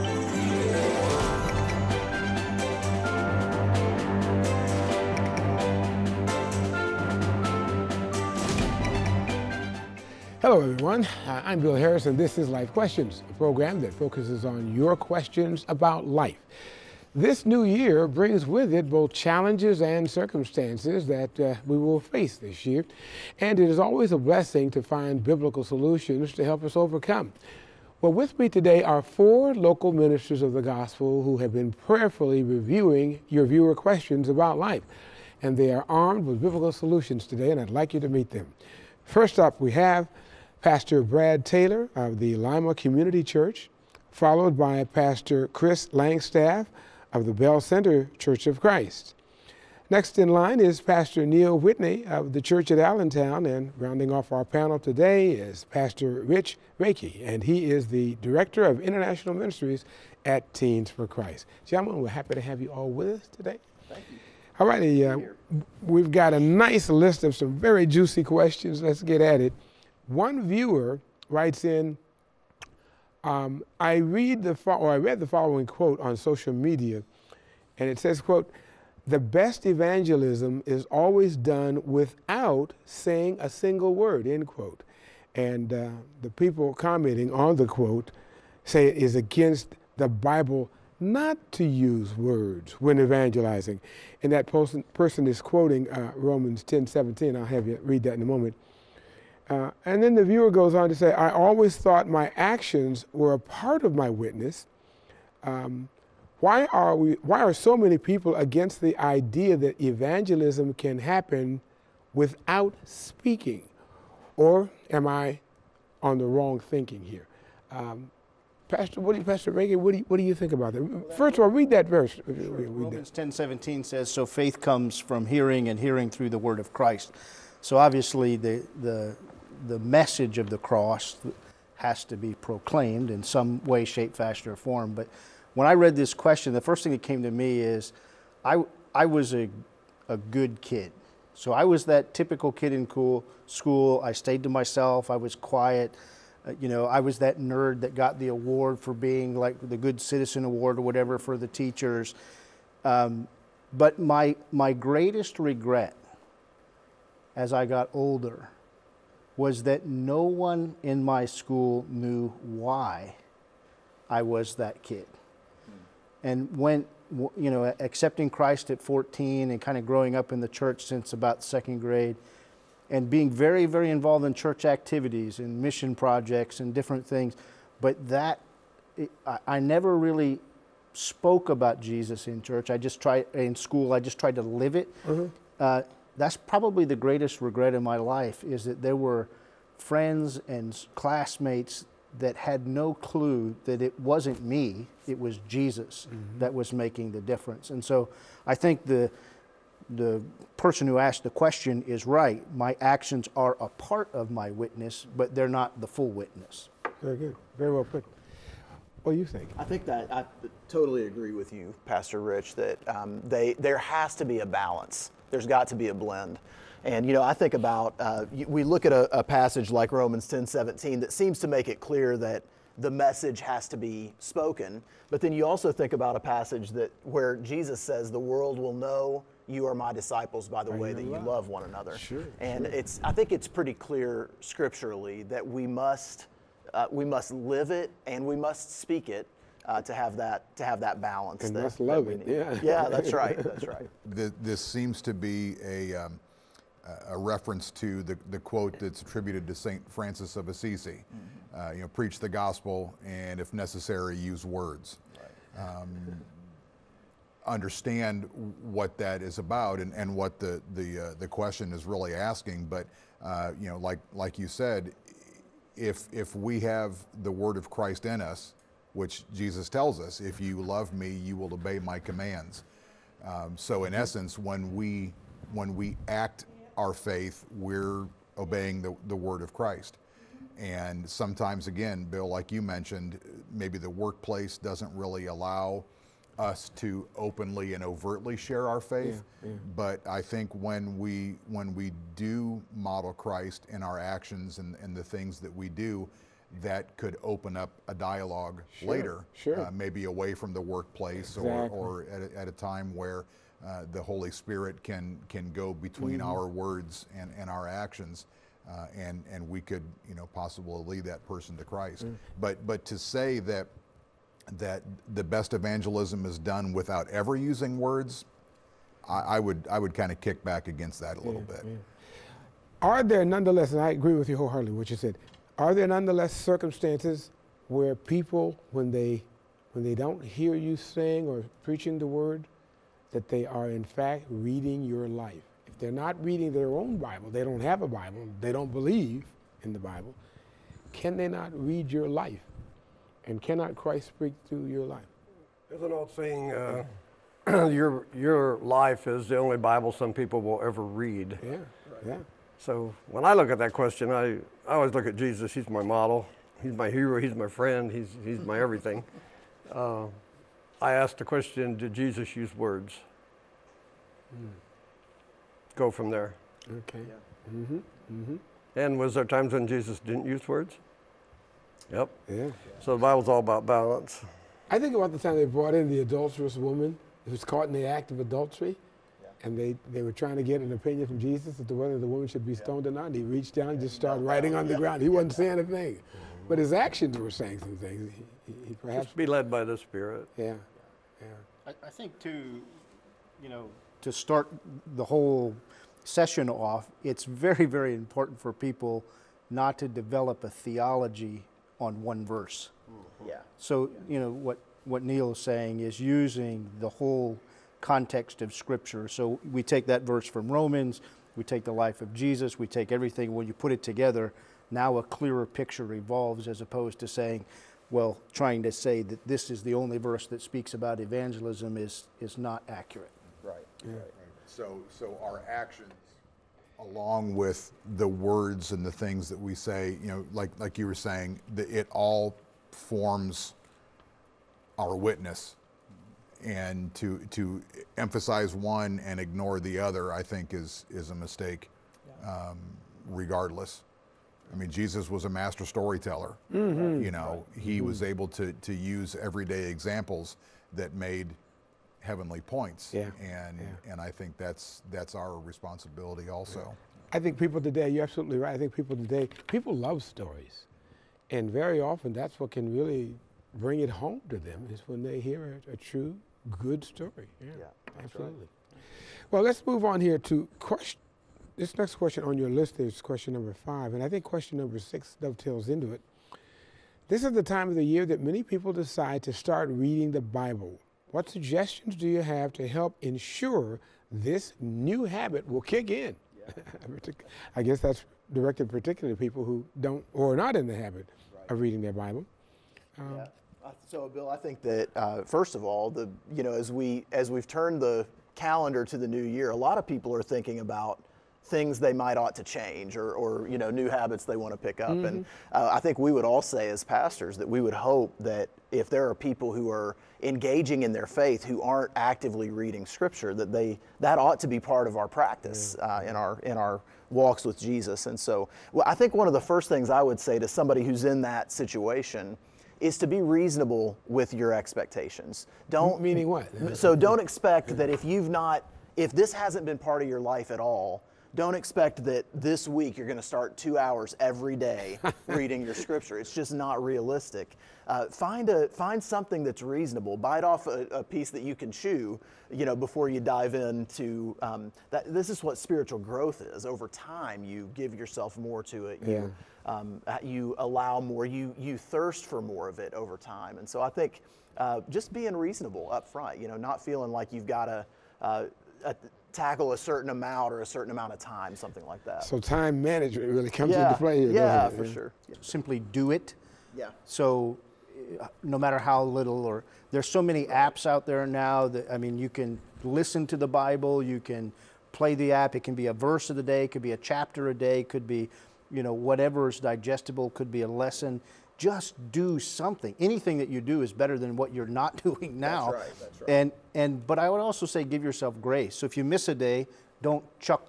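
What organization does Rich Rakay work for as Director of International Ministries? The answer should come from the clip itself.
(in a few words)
Teens for Christ.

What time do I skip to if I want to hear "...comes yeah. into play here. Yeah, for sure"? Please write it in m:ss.
9:23.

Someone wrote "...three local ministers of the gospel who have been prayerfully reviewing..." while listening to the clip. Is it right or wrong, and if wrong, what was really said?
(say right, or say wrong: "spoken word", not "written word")
wrong: "four", not "three".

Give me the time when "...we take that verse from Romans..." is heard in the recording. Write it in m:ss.
6:49.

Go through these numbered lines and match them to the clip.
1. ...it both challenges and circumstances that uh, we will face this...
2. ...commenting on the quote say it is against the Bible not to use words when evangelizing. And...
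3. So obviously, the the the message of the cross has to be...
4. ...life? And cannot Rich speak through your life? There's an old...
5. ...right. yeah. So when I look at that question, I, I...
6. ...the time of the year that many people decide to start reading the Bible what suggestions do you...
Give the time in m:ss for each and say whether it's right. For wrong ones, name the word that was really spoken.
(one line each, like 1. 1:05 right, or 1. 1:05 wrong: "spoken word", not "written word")
1. 0:18 right
2. 1:26 right
3. 2:07 right
4. 5:42 wrong: "Christ", not "Rich"
5. 5:51 right
6. 7:57 right.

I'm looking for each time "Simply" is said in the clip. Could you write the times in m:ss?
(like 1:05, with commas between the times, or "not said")
9:25.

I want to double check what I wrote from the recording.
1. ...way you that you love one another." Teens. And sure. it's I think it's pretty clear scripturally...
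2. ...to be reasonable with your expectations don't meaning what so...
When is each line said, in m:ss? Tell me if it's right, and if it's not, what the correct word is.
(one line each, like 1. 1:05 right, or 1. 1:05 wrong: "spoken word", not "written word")
1. 3:50 wrong: "Sure", not "Teens"
2. 8:42 right.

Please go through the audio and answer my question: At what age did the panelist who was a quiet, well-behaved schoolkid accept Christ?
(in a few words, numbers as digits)
14.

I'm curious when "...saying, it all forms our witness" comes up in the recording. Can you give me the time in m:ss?
7:10.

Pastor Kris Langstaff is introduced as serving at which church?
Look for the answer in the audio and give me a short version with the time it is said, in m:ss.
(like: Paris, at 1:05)
Belle Center Church of Christ, at 0:47.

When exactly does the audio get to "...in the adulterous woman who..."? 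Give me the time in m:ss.
6:15.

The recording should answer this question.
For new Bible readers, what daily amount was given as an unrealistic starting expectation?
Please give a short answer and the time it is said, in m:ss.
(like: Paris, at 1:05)
2 hours, at 8:53.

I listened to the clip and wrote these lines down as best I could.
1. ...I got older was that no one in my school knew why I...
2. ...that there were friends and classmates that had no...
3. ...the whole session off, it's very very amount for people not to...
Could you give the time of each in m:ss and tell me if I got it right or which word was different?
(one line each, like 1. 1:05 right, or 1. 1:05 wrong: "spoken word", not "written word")
1. 2:37 right
2. 3:08 right
3. 6:34 wrong: "important", not "amount".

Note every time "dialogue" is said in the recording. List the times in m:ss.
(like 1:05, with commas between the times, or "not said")
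4:57.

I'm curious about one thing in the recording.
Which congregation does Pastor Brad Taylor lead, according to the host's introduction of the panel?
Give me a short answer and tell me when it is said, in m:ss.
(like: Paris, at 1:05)
Lima Community Church, at 0:42.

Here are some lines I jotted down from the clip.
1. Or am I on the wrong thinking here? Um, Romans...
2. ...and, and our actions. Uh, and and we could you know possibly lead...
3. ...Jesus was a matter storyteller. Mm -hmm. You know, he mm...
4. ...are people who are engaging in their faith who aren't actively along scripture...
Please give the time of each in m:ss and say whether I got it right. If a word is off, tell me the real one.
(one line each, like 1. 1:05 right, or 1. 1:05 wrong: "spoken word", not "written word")
1. 1:54 wrong: "Pastor", not "Romans"
2. 5:07 right
3. 7:24 wrong: "master", not "matter"
4. 8:29 wrong: "reading", not "along".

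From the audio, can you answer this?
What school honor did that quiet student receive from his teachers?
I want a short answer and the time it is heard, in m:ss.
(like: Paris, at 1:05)
Good Citizen Award, at 2:29.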